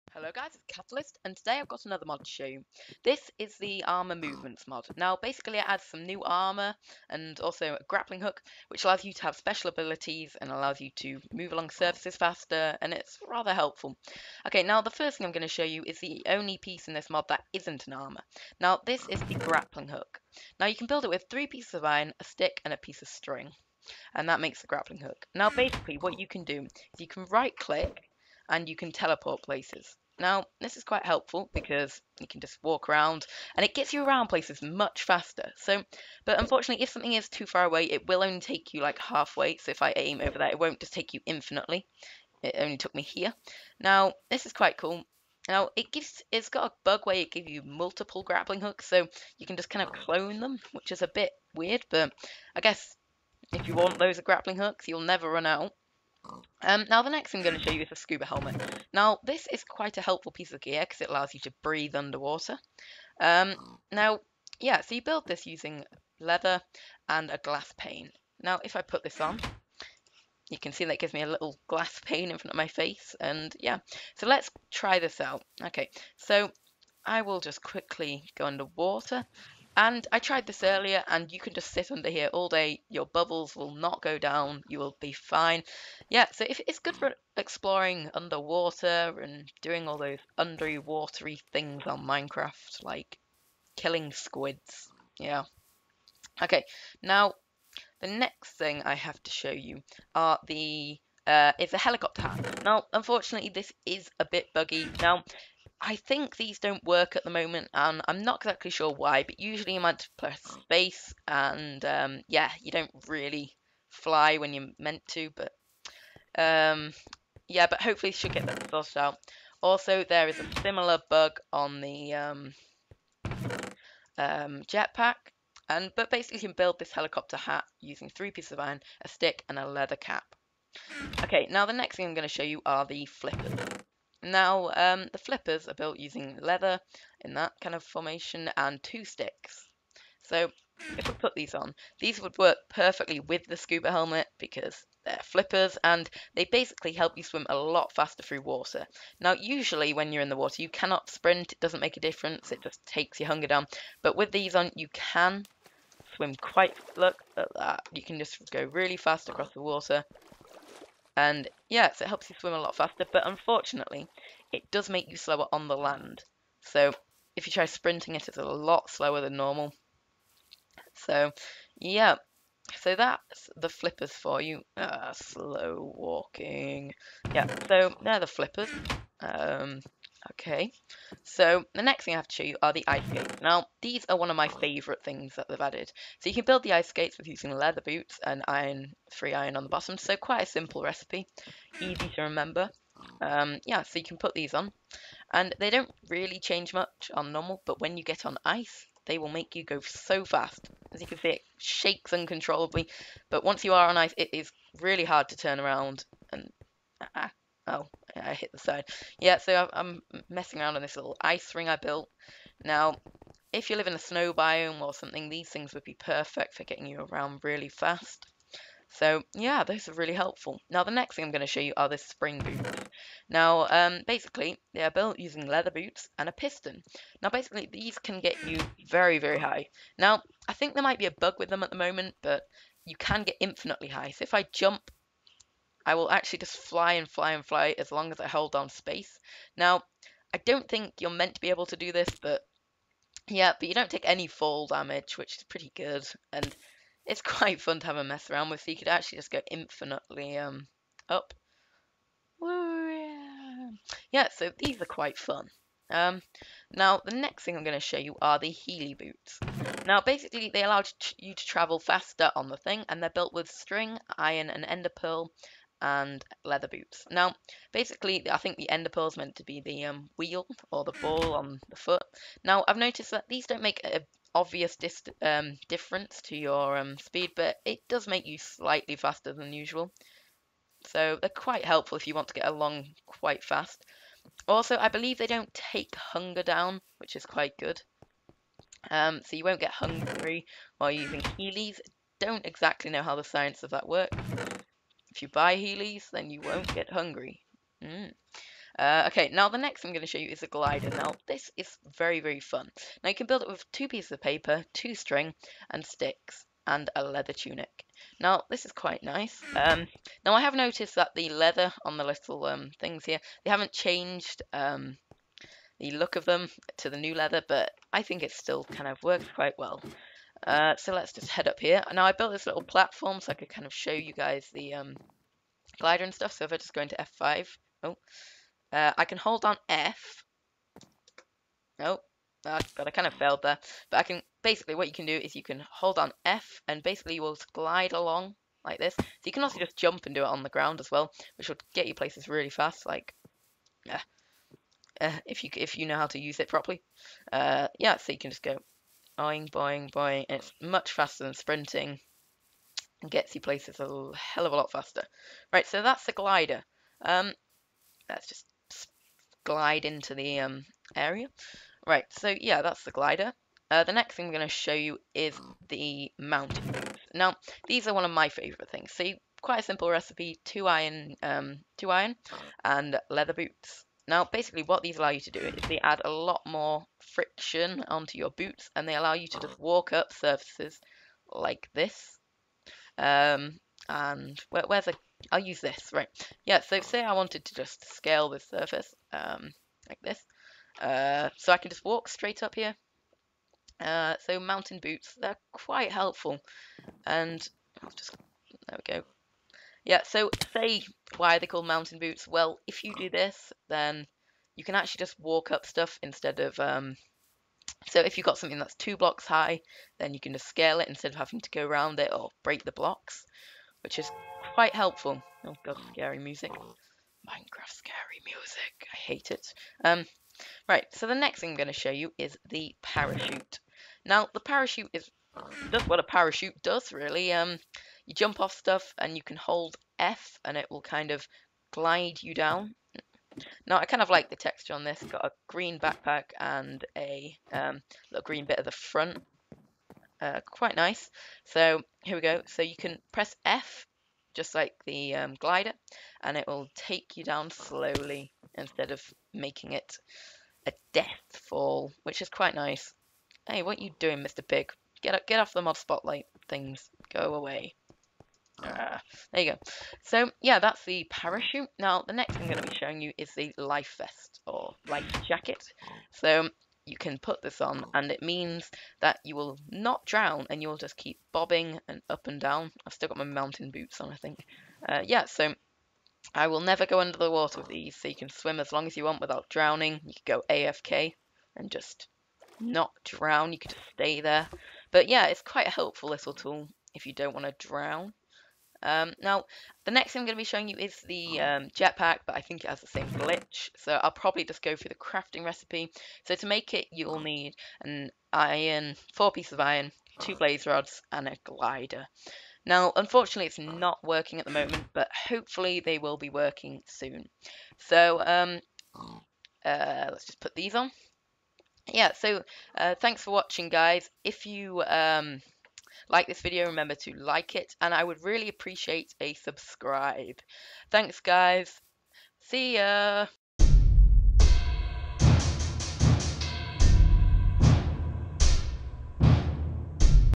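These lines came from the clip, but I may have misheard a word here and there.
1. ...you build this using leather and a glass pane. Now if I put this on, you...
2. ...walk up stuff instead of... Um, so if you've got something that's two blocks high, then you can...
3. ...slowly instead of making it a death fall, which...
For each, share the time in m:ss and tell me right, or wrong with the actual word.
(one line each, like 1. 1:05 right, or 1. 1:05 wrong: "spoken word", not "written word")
1. 1:04 right
2. 6:45 right
3. 7:27 right.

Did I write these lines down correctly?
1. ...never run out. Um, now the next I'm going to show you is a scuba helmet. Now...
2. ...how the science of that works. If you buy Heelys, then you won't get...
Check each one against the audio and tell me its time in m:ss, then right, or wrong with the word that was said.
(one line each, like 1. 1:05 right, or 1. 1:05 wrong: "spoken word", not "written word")
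1. 0:55 right
2. 4:53 right.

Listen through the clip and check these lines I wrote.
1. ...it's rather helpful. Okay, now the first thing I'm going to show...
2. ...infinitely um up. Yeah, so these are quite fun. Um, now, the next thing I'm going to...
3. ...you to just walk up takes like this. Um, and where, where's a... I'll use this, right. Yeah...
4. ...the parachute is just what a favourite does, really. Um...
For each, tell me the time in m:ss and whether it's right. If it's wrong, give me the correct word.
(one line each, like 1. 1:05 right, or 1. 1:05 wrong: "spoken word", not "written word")
1. 0:12 right
2. 4:09 right
3. 6:19 wrong: "surfaces", not "takes"
4. 7:04 wrong: "parachute", not "favourite".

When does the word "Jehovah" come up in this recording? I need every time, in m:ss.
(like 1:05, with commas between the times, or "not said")
not said.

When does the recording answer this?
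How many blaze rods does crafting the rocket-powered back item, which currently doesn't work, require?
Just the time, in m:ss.
8:20.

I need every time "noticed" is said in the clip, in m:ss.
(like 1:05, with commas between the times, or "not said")
4:32, 5:10.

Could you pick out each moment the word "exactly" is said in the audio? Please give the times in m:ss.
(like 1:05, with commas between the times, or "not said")
1:48, 4:52.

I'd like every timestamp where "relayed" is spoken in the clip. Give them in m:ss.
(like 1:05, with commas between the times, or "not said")
not said.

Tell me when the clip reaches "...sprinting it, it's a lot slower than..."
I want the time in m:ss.
2:47.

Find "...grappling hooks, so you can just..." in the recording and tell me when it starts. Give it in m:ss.
0:48.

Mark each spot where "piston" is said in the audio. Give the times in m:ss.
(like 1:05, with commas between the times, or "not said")
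3:46.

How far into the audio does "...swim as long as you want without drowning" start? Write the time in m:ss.
7:58.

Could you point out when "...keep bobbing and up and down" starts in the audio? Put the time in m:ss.
7:50.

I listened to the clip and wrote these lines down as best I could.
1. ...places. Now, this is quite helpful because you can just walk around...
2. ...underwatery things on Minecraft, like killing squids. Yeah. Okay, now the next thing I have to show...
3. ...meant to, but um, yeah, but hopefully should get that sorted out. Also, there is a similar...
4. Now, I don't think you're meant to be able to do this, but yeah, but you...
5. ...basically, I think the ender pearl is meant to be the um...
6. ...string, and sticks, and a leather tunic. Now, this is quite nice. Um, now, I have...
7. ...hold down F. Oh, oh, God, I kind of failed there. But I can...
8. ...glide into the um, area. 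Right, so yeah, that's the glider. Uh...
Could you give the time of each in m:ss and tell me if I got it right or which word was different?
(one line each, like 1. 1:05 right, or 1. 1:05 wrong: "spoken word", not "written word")
1. 0:29 right
2. 1:30 right
3. 1:54 right
4. 3:59 right
5. 4:27 right
6. 5:04 right
7. 5:29 right
8. 5:59 right.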